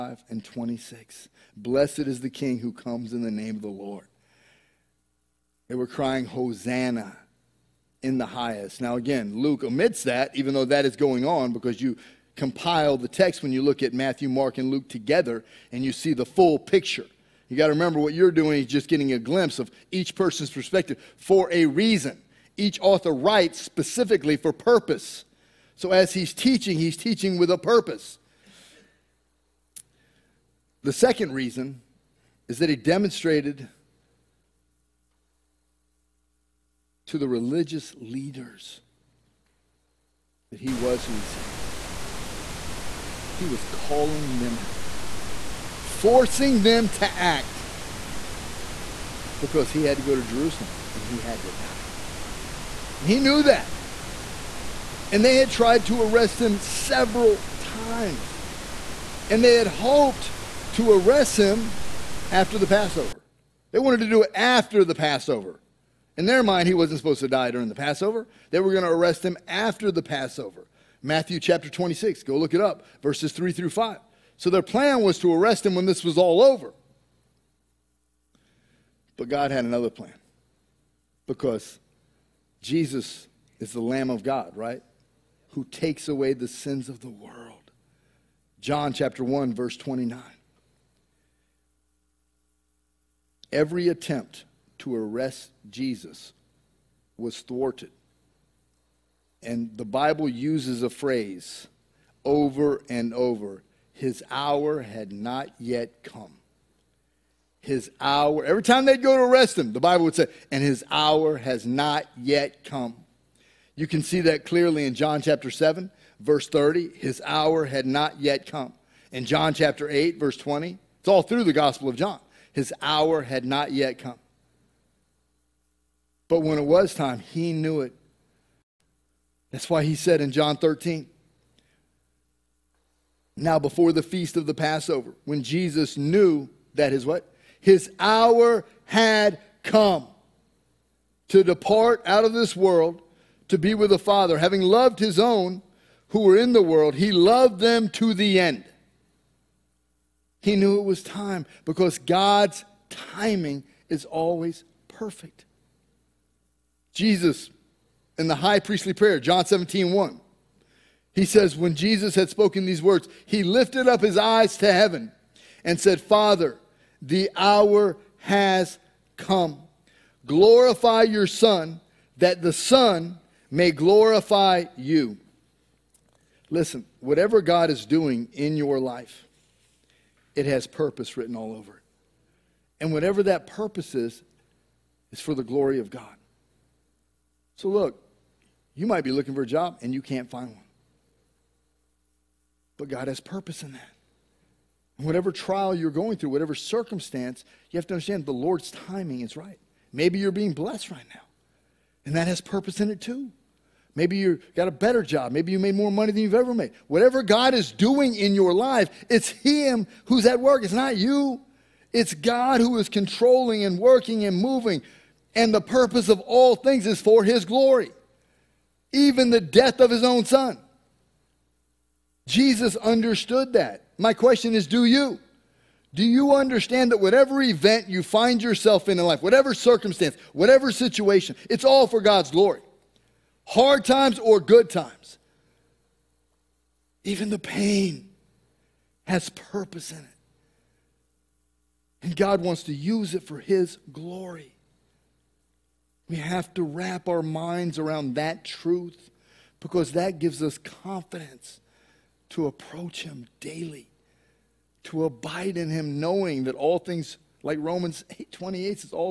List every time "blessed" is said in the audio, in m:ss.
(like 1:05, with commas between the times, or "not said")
0:01, 3:20.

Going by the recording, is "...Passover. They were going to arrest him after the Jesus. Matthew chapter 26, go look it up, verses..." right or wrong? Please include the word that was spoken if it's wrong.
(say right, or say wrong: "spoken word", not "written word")
wrong: "Passover", not "Jesus".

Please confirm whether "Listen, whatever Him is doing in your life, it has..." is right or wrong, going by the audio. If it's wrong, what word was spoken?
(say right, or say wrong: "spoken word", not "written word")
wrong: "God", not "Him".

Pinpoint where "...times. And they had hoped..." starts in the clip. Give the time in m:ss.
0:57.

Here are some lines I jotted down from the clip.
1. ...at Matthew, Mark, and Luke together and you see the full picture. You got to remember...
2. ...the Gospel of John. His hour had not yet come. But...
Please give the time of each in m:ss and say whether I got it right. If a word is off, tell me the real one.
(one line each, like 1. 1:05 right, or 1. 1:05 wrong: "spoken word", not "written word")
1. 0:13 right
2. 2:01 right.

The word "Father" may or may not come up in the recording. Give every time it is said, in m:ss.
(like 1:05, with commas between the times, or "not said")
2:23, 2:46.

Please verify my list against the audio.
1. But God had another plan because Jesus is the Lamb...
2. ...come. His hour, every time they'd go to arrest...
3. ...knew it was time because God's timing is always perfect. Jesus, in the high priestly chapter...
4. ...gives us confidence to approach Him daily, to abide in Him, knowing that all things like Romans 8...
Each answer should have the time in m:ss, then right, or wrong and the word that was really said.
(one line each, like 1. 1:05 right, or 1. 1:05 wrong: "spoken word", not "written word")
1. 1:19 right
2. 1:46 right
3. 2:30 wrong: "prayer", not "chapter"
4. 4:10 right.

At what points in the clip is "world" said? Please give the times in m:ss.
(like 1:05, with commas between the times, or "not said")
1:27, 2:22, 2:26.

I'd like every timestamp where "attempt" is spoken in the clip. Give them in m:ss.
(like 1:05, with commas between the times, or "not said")
1:33.